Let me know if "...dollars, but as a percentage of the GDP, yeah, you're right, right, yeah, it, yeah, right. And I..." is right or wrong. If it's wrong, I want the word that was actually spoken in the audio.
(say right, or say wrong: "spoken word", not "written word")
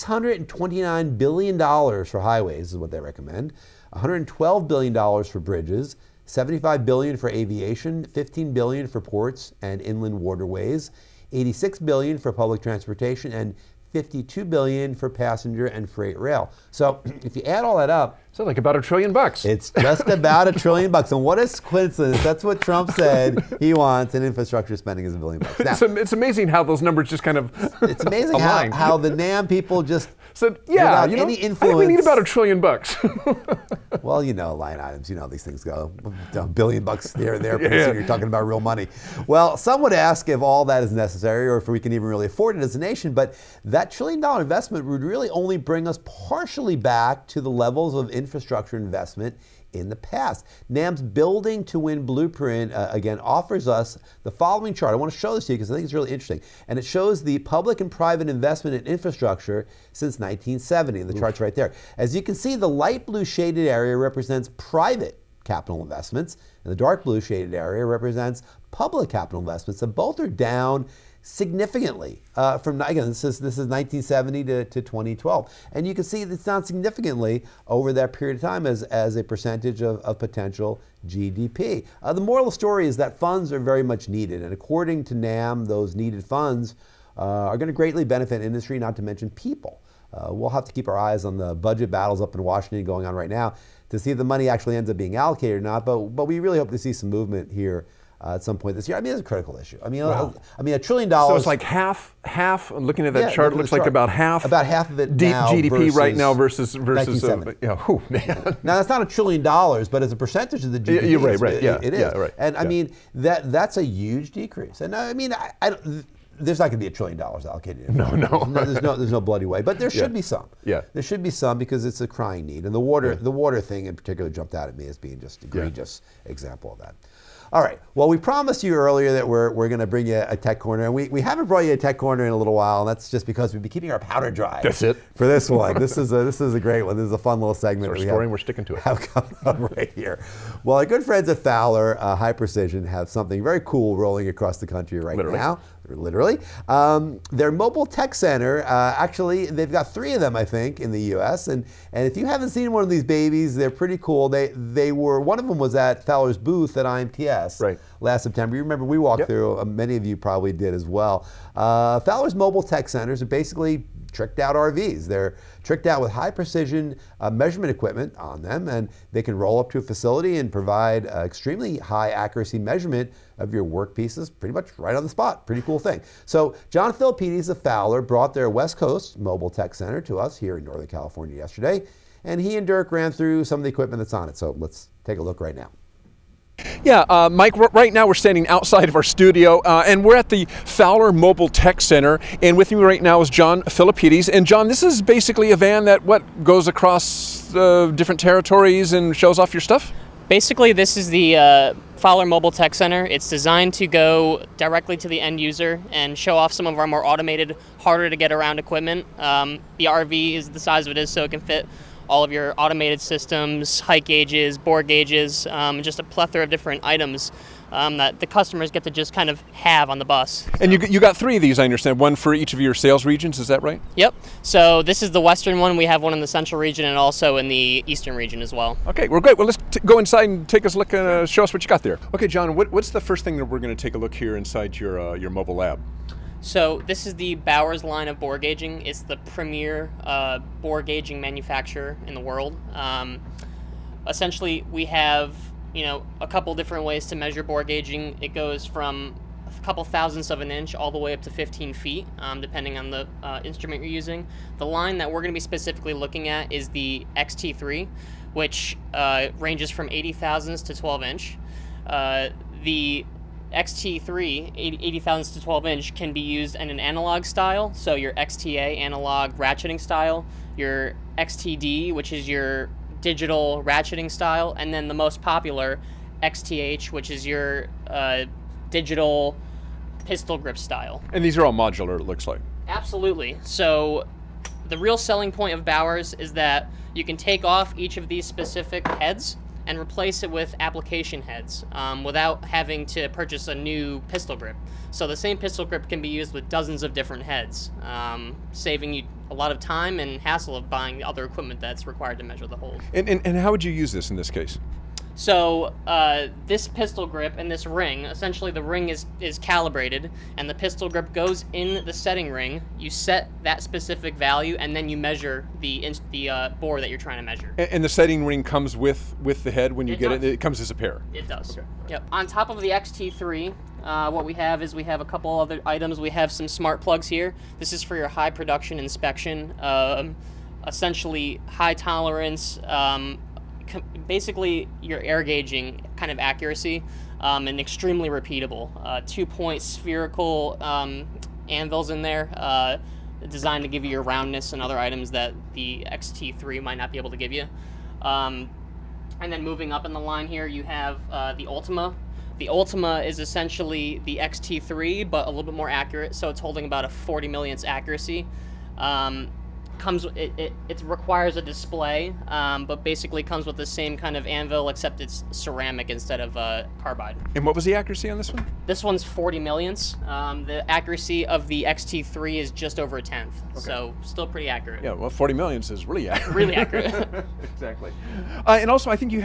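right.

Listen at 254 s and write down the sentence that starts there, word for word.
The line that we're going to be specifically looking at is the XT3, which uh, ranges from 80 thousandths to 12 inch.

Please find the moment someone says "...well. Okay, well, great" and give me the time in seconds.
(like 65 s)
228 s.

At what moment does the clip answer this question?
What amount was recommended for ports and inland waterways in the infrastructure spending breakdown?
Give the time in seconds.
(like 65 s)
8 s.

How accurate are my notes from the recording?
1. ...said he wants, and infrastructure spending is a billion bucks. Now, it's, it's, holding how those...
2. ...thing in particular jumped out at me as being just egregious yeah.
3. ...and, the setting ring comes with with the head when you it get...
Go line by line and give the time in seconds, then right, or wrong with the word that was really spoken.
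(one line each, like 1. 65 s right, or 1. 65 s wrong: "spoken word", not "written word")
1. 22 s wrong: "amazing", not "holding"
2. 123 s right
3. 317 s right.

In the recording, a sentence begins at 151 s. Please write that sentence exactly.
And and if you haven't seen one of these babies, they're pretty cool.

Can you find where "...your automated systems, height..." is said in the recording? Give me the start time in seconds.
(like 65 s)
212 s.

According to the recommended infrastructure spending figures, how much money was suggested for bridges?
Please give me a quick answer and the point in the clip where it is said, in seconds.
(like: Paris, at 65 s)
$112 billion, at 3 s.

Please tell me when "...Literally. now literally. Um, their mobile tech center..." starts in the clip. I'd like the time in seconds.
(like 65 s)
145 s.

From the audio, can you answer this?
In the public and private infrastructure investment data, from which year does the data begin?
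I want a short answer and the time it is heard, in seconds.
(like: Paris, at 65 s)
1970, at 59 s.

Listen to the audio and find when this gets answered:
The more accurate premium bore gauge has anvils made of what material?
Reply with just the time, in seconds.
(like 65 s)
365 s.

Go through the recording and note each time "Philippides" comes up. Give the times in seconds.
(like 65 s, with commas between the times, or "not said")
176 s, 193 s.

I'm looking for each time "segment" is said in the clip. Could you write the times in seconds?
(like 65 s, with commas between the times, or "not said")
137 s.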